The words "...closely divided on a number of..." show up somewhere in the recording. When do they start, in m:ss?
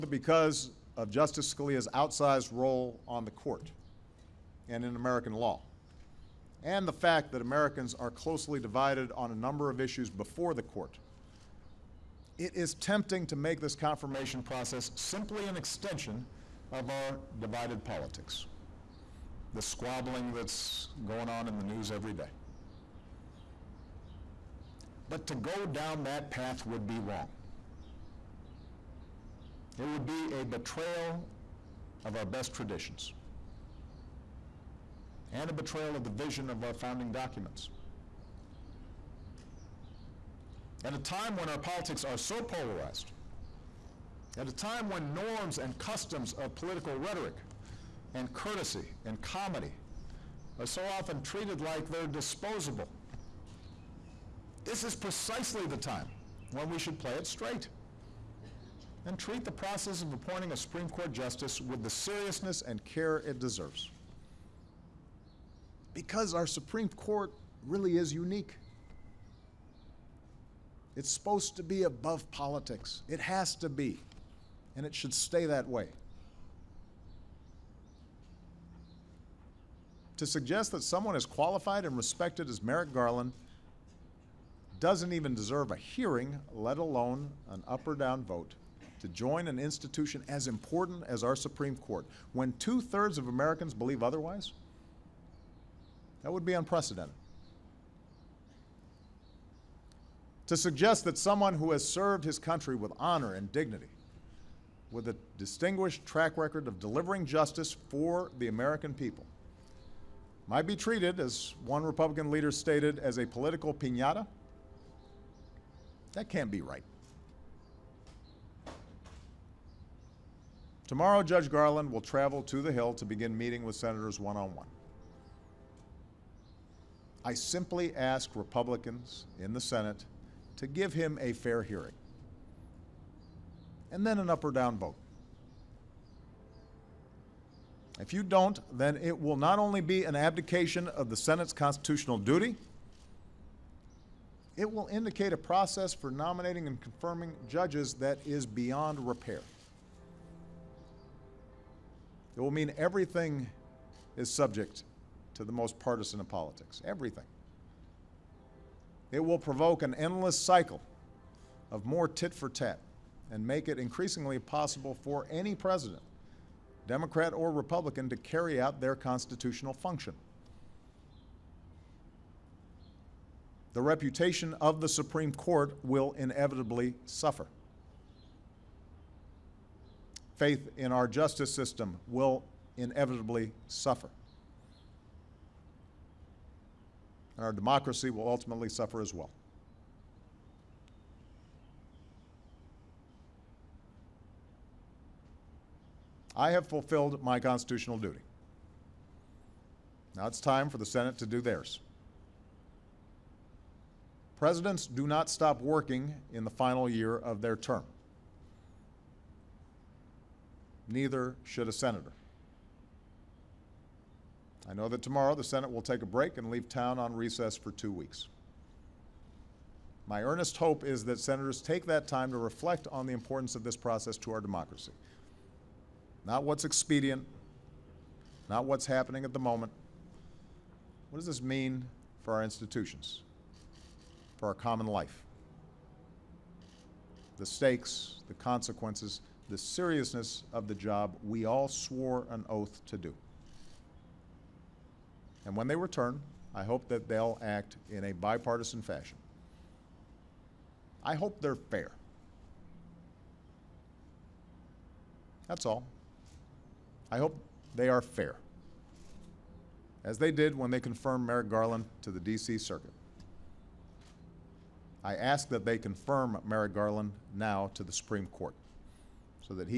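0:08.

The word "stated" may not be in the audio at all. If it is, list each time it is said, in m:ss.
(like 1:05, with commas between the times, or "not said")
1:52.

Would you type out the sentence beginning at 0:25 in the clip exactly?
But to go down that path would be wrong.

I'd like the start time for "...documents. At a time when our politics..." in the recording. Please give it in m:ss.
0:37.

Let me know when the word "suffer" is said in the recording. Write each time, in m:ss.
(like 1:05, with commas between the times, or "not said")
2:57, 3:03, 3:08.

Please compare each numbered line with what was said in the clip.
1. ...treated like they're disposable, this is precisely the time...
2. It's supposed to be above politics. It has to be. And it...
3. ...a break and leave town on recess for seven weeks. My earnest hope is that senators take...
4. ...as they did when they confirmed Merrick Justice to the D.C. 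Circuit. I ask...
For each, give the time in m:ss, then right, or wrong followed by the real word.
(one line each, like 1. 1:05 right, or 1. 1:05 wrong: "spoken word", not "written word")
1. 0:51 right
2. 1:10 right
3. 3:36 wrong: "two", not "seven"
4. 4:20 wrong: "Garland", not "Justice".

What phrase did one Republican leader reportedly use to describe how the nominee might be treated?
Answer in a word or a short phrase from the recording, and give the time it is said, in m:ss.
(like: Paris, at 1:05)
Political pinata, at 1:53.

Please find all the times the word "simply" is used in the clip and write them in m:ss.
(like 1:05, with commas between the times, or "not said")
0:14, 2:07.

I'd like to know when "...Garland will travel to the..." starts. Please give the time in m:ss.
2:01.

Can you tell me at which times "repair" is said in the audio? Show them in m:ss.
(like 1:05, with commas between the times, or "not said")
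2:29.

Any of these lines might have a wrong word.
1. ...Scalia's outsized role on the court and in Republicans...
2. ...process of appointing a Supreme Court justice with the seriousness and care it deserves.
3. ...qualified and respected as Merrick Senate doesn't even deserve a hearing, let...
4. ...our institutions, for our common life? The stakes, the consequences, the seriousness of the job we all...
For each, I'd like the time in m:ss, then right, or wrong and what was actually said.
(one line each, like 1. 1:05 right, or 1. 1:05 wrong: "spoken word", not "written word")
1. 0:01 wrong: "American", not "Republicans"
2. 0:59 right
3. 1:21 wrong: "Garland", not "Senate"
4. 3:52 right.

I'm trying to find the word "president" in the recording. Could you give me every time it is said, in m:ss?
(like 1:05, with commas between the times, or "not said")
2:45, 3:24.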